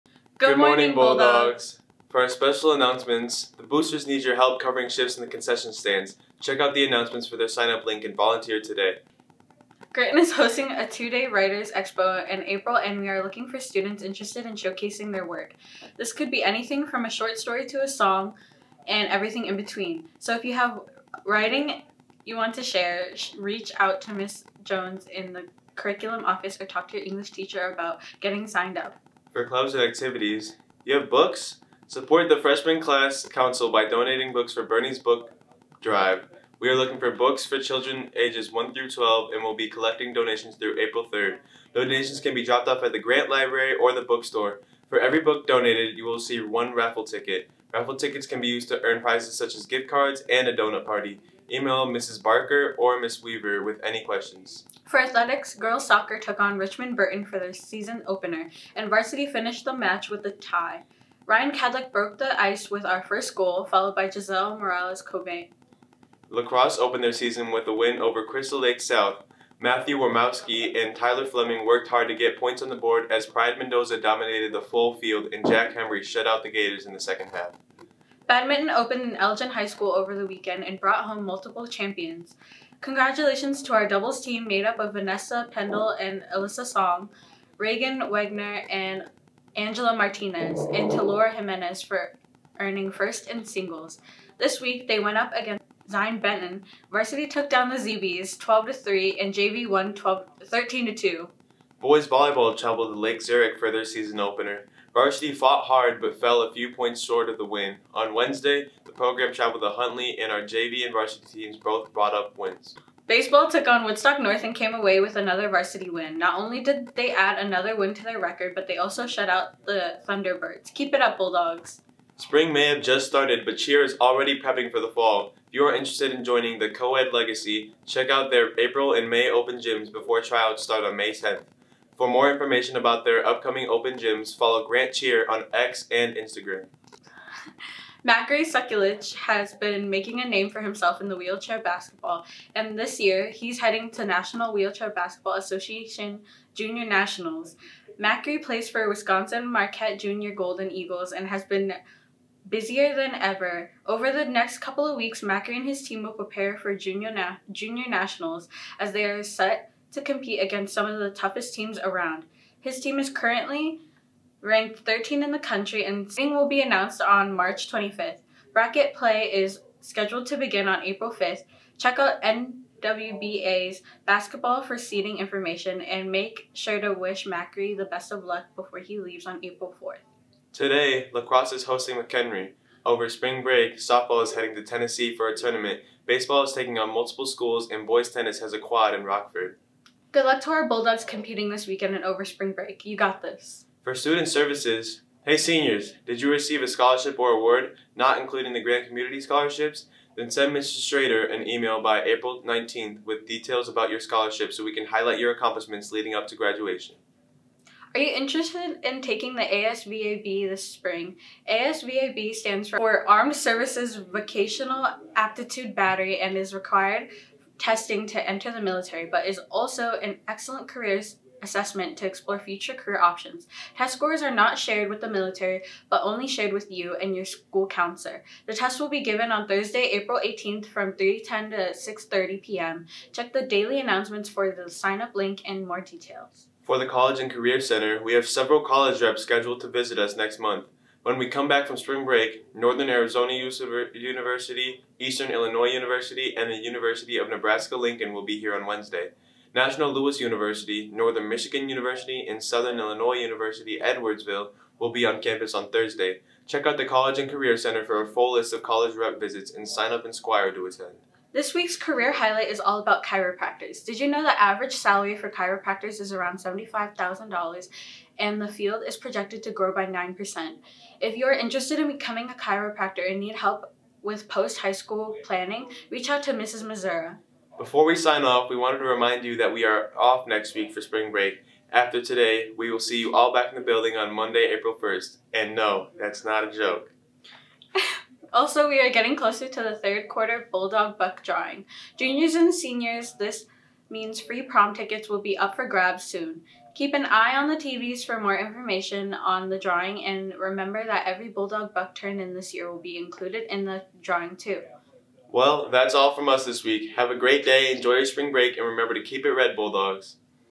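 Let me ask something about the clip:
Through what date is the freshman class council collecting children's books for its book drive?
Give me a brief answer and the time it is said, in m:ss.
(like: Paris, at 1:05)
April 3rd, at 0:40.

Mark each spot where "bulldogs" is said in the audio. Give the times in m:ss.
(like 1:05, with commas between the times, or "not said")
0:00, 2:01, 3:10, 4:50, 5:01, 5:09.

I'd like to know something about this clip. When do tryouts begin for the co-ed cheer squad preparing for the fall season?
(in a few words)
May 10th.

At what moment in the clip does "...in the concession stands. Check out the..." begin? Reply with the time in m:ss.
0:05.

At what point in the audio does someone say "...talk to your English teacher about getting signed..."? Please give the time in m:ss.
0:26.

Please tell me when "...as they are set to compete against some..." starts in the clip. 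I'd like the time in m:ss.
2:38.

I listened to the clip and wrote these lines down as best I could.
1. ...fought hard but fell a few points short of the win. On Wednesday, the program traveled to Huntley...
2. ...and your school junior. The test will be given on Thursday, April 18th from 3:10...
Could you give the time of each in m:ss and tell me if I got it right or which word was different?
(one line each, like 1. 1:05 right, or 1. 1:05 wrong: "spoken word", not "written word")
1. 1:45 right
2. 3:47 wrong: "counselor", not "junior".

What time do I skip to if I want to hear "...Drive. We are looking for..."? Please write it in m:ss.
0:35.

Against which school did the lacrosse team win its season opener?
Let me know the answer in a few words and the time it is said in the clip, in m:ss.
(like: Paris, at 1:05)
Crystal Lake South, at 1:08.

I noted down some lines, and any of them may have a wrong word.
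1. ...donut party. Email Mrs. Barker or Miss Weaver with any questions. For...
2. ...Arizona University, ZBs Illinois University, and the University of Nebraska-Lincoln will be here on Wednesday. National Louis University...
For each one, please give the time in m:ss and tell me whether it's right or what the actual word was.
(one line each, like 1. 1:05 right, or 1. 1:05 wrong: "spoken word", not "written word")
1. 0:50 right
2. 4:02 wrong: "Eastern", not "ZBs".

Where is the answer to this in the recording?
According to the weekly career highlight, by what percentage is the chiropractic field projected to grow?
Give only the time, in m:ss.
4:29.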